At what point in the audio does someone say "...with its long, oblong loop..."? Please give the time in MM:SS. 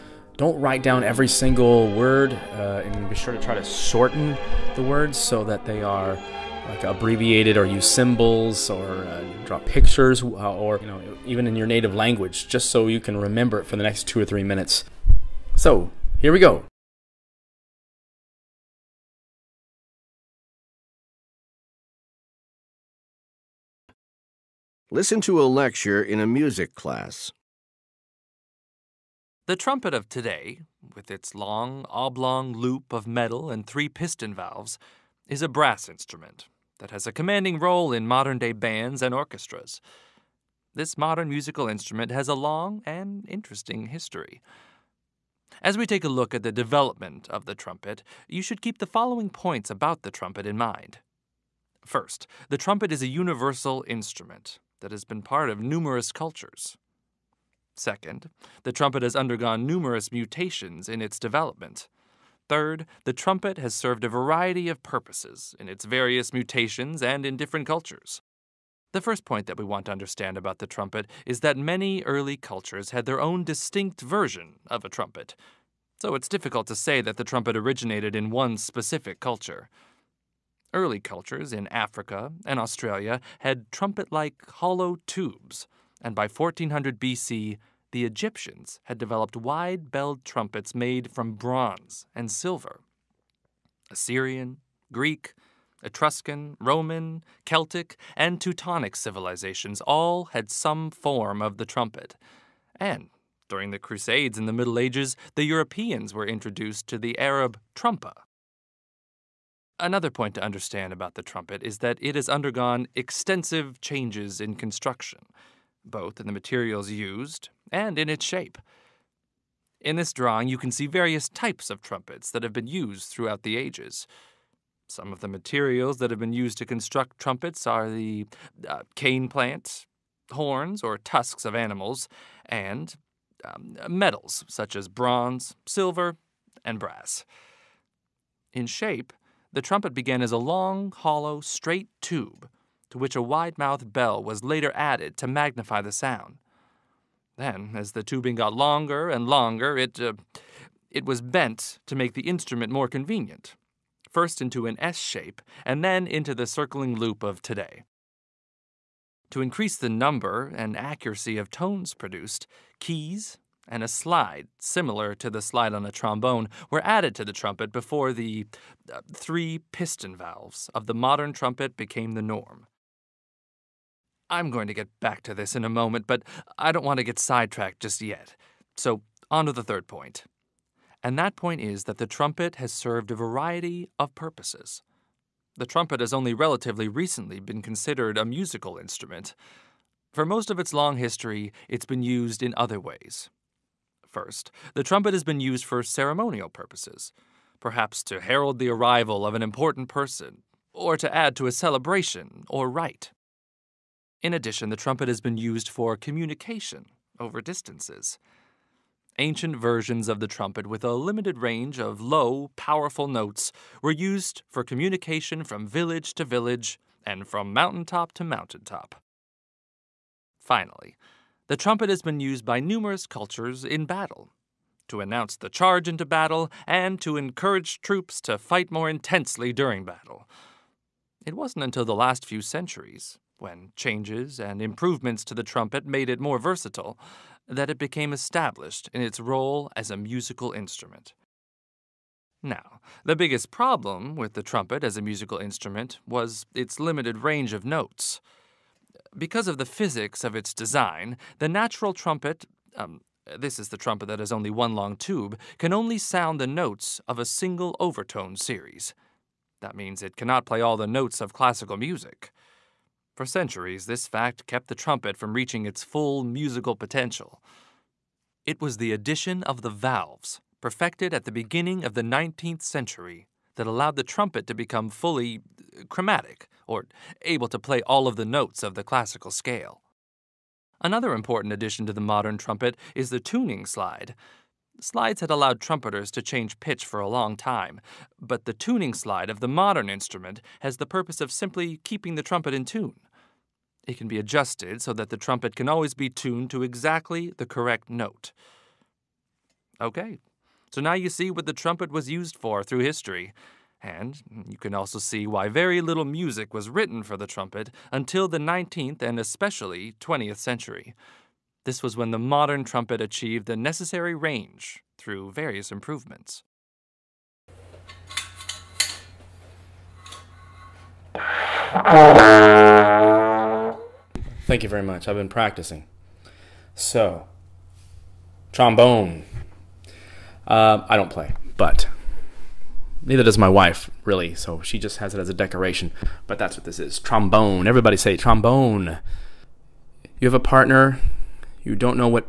00:30.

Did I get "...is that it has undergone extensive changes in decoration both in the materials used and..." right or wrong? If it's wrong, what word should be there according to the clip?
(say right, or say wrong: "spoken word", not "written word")
wrong: "construction", not "decoration".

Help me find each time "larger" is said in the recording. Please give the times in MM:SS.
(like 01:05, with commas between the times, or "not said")
not said.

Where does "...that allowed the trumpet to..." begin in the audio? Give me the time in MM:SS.
04:33.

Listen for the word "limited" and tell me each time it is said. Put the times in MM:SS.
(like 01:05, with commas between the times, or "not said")
03:30, 04:06.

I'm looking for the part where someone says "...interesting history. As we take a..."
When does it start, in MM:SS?
00:43.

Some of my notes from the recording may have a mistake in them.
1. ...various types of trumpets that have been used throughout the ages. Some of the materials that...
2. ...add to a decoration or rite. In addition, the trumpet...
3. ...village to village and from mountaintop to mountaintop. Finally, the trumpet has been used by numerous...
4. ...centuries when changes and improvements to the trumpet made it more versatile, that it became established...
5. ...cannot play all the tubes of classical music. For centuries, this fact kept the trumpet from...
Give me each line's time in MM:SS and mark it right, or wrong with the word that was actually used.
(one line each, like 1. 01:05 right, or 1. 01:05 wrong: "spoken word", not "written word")
1. 02:00 right
2. 03:21 wrong: "celebration", not "decoration"
3. 03:35 right
4. 03:52 right
5. 04:20 wrong: "notes", not "tubes".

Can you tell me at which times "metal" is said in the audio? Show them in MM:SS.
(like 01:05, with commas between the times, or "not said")
00:33, 02:13.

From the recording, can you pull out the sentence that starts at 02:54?
I'm going to get back to this in a moment, but I don't want to get sidetracked just yet.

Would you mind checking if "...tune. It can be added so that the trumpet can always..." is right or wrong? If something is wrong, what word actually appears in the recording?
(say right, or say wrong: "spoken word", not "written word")
wrong: "adjusted", not "added".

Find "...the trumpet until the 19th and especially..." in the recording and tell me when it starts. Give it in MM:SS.
05:07.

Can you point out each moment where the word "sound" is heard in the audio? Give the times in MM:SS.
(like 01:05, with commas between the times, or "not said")
02:25, 04:15.